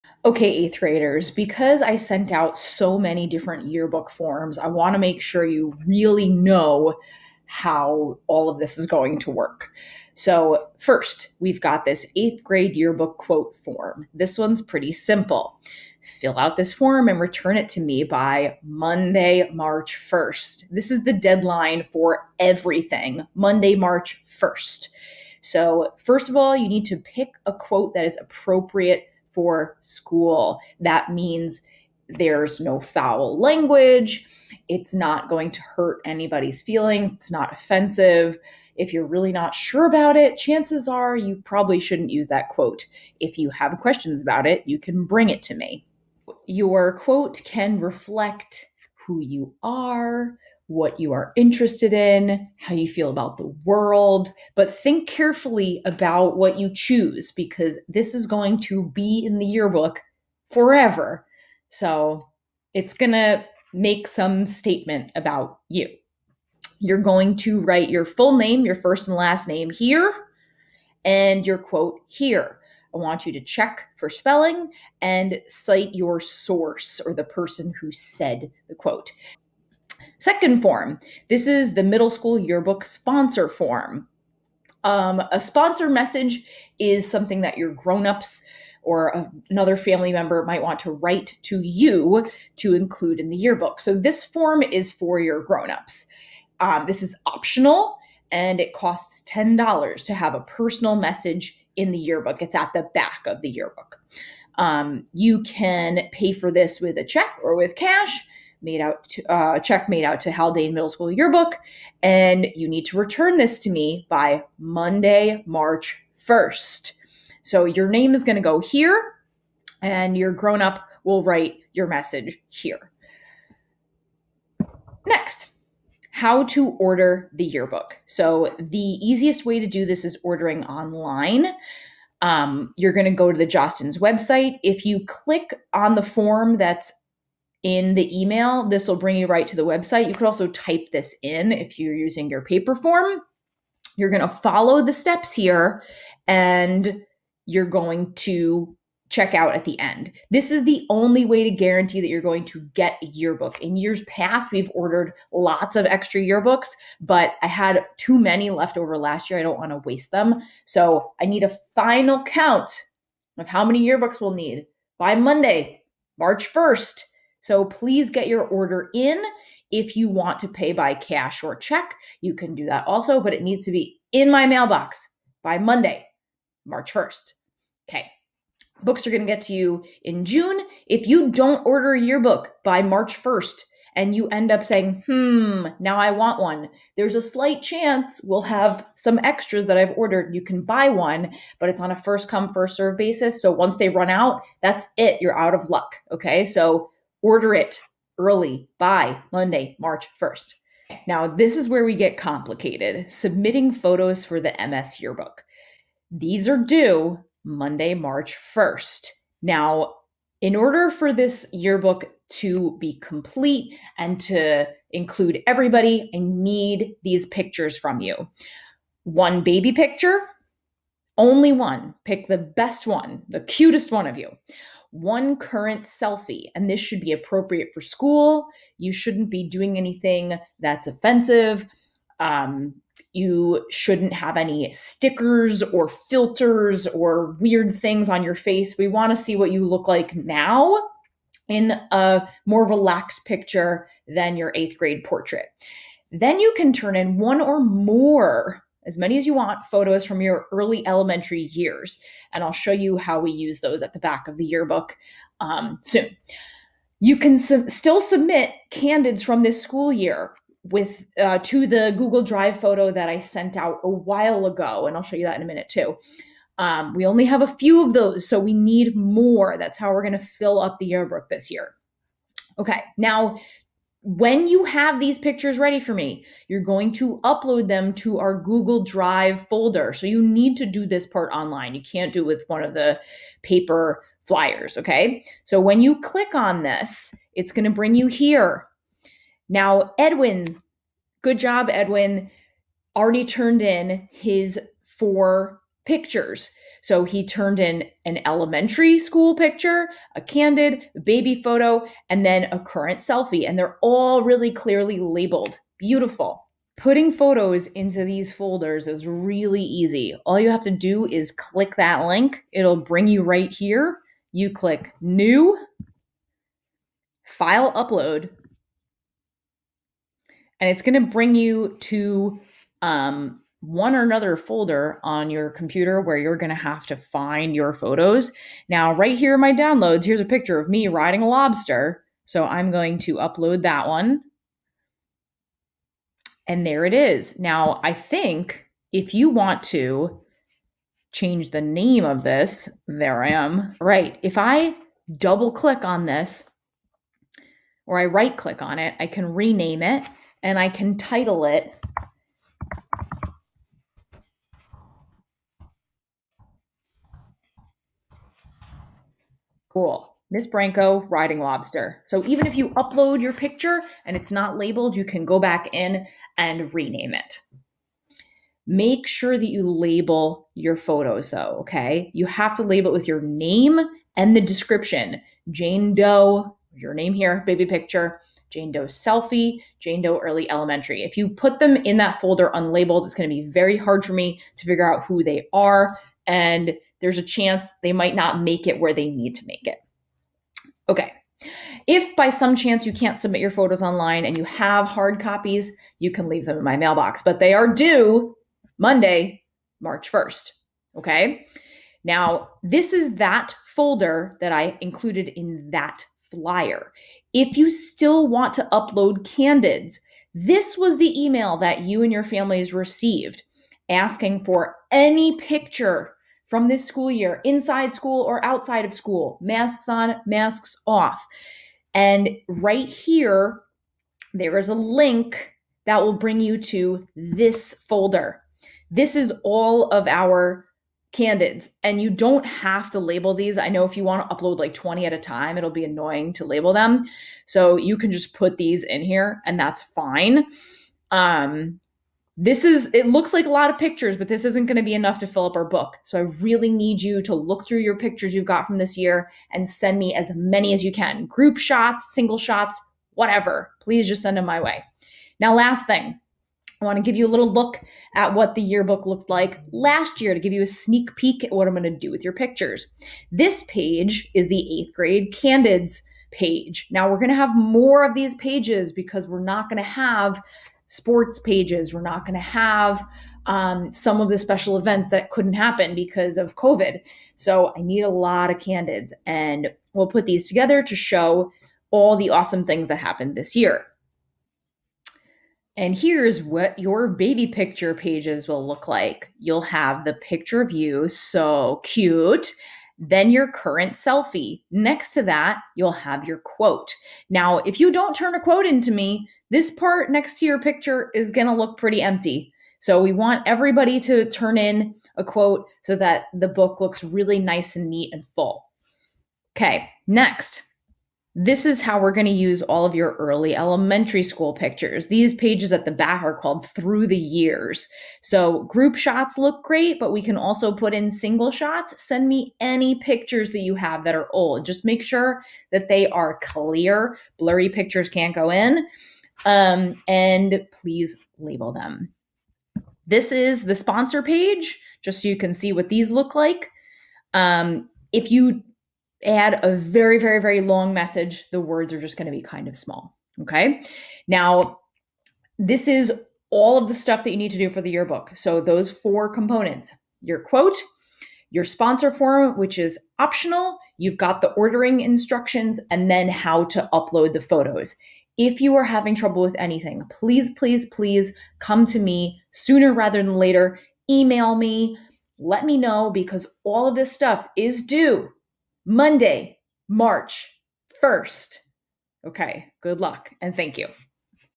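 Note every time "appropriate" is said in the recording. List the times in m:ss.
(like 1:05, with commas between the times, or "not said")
0:28, 3:47.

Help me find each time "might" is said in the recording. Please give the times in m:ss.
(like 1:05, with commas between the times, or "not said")
1:30, 6:27.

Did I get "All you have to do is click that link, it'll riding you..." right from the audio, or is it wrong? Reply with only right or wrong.
wrong.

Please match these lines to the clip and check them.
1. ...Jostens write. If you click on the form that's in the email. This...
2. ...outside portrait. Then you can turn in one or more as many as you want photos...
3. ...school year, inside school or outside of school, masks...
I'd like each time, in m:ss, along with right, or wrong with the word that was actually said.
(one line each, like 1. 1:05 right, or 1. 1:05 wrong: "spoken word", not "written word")
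1. 2:13 wrong: "website", not "write"
2. 4:04 wrong: "grade", not "outside"
3. 6:56 right.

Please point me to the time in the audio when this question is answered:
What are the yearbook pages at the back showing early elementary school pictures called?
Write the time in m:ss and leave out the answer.
8:36.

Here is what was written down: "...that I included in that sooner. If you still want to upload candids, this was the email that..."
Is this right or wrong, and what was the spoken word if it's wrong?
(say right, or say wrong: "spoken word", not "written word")
wrong: "flyer", not "sooner".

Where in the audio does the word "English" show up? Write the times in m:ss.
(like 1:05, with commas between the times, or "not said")
not said.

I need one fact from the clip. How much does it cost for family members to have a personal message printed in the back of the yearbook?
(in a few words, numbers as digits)
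$10.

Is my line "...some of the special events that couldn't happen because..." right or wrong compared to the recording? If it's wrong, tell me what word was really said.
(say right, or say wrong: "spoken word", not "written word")
right.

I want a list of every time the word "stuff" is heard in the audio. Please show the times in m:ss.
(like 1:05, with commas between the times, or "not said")
9:06, 9:27.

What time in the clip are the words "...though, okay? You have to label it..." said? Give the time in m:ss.
6:11.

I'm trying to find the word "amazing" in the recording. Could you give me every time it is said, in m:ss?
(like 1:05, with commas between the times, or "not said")
not said.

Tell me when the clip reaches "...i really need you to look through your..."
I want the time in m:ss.
7:26.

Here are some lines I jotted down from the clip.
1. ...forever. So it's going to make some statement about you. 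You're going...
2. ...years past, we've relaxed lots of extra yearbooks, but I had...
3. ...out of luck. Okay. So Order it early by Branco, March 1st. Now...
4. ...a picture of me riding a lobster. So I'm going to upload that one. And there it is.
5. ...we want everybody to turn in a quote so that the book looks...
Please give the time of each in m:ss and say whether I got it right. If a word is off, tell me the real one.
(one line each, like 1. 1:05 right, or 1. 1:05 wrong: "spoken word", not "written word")
1. 1:00 right
2. 2:33 wrong: "ordered", not "relaxed"
3. 3:15 wrong: "Monday", not "Branco"
4. 5:30 right
5. 8:23 right.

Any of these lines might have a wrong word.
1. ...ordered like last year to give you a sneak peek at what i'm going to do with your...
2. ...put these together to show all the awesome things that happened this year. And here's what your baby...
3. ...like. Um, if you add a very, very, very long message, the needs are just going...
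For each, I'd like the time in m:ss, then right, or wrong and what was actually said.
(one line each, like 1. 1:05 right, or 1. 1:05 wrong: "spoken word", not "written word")
1. 7:39 wrong: "looked", not "ordered"
2. 8:00 right
3. 8:56 wrong: "words", not "needs".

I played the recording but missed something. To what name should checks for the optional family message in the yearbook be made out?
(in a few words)
Haldane Middle School yearbook.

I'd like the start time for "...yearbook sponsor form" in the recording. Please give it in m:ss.
1:22.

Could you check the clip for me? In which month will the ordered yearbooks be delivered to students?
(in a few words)
June.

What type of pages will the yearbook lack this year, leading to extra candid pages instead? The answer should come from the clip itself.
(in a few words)
sports pages.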